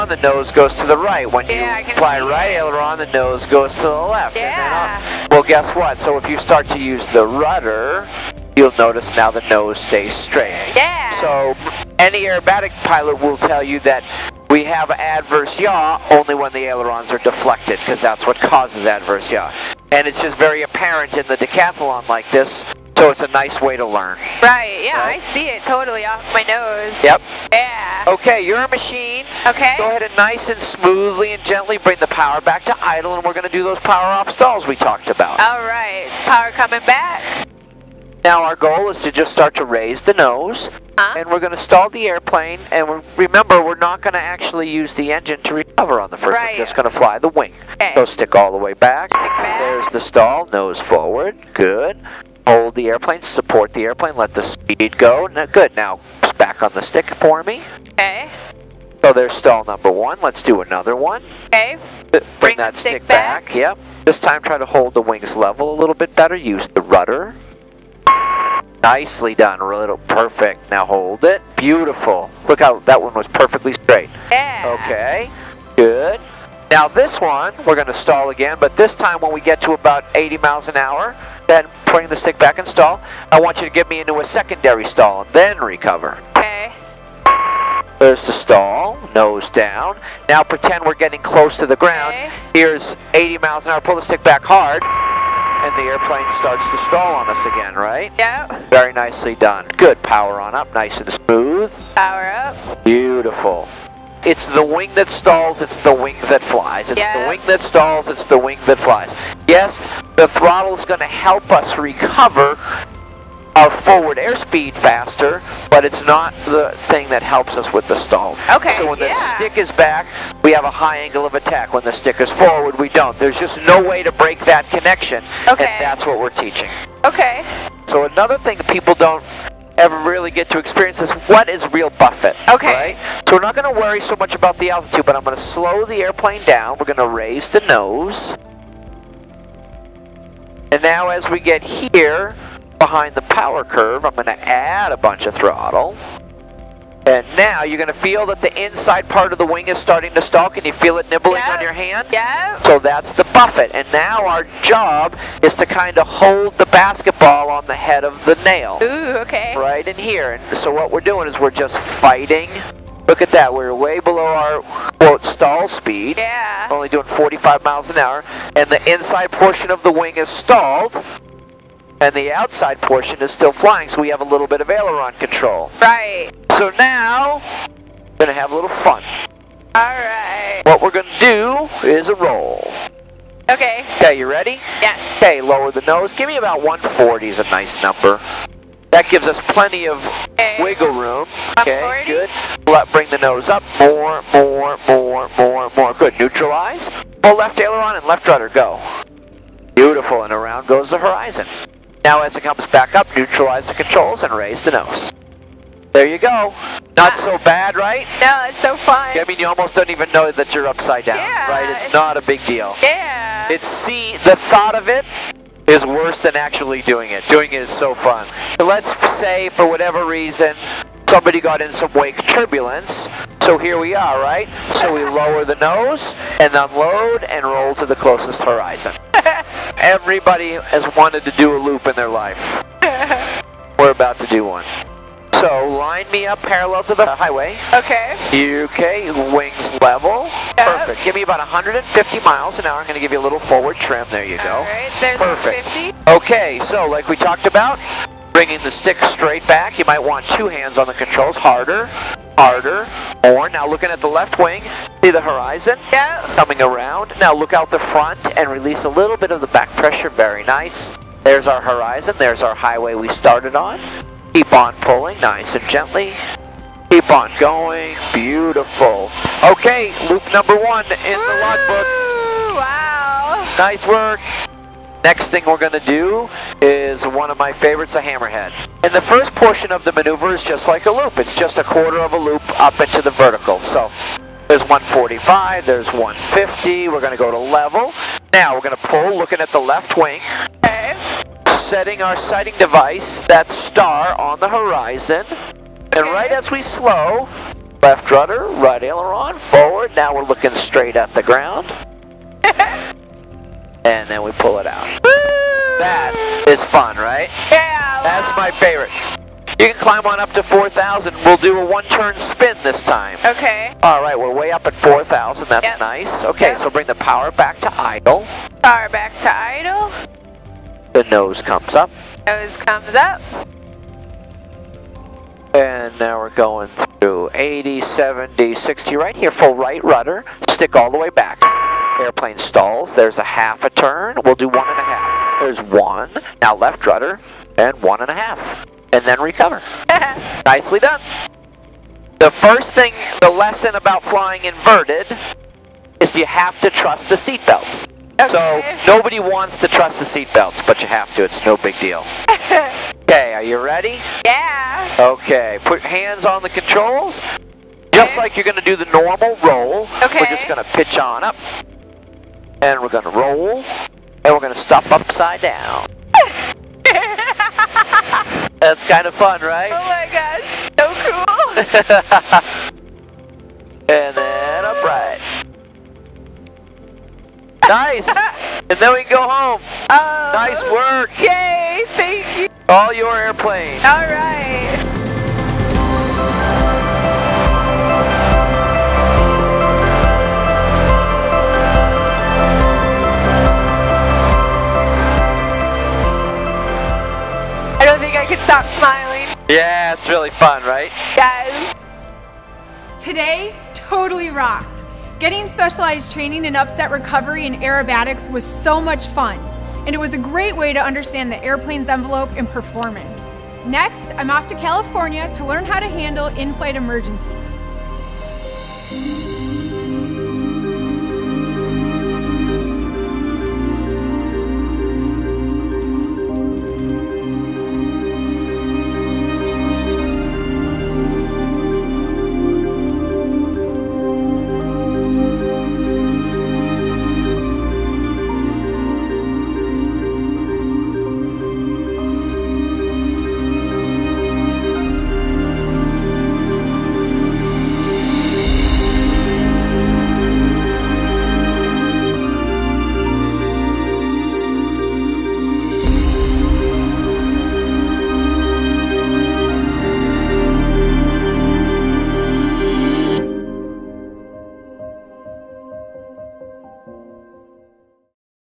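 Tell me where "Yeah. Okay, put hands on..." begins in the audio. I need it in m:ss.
5:54.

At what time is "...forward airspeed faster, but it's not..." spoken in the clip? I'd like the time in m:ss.
1:53.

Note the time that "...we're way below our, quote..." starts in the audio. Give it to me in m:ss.
2:43.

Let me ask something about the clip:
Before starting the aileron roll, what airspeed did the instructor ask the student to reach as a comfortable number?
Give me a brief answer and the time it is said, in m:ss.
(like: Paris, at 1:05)
140, at 3:06.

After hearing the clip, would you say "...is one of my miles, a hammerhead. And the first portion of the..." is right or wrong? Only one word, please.
wrong.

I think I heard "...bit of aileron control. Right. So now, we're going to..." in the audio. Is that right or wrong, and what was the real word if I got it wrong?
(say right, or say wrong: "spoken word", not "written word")
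right.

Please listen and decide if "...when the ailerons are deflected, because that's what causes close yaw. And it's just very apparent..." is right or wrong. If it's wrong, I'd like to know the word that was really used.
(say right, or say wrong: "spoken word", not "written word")
wrong: "adverse", not "close".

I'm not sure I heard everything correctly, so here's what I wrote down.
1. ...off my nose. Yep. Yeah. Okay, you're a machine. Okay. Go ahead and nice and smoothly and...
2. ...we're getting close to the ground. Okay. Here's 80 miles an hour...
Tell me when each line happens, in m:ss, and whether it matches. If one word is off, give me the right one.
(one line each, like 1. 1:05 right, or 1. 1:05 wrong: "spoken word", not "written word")
1. 0:26 right
2. 1:30 right.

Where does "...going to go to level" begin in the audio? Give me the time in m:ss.
4:47.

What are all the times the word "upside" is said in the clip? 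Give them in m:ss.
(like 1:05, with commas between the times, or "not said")
3:30, 6:04.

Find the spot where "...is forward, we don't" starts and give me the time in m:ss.
2:02.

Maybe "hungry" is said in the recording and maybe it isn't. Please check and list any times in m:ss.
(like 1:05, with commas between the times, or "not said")
not said.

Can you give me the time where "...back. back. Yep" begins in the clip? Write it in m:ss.
1:03.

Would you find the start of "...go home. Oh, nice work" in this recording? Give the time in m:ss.
6:19.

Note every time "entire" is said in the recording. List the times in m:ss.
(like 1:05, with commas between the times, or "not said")
not said.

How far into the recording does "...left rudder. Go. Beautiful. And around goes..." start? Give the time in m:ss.
3:18.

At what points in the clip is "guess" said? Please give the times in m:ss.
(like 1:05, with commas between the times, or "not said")
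0:05.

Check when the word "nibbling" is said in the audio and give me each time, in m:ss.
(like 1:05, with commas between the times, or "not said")
2:31.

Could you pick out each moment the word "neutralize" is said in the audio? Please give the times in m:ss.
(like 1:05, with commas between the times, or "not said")
3:16, 3:23.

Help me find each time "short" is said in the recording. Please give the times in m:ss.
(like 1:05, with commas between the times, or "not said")
not said.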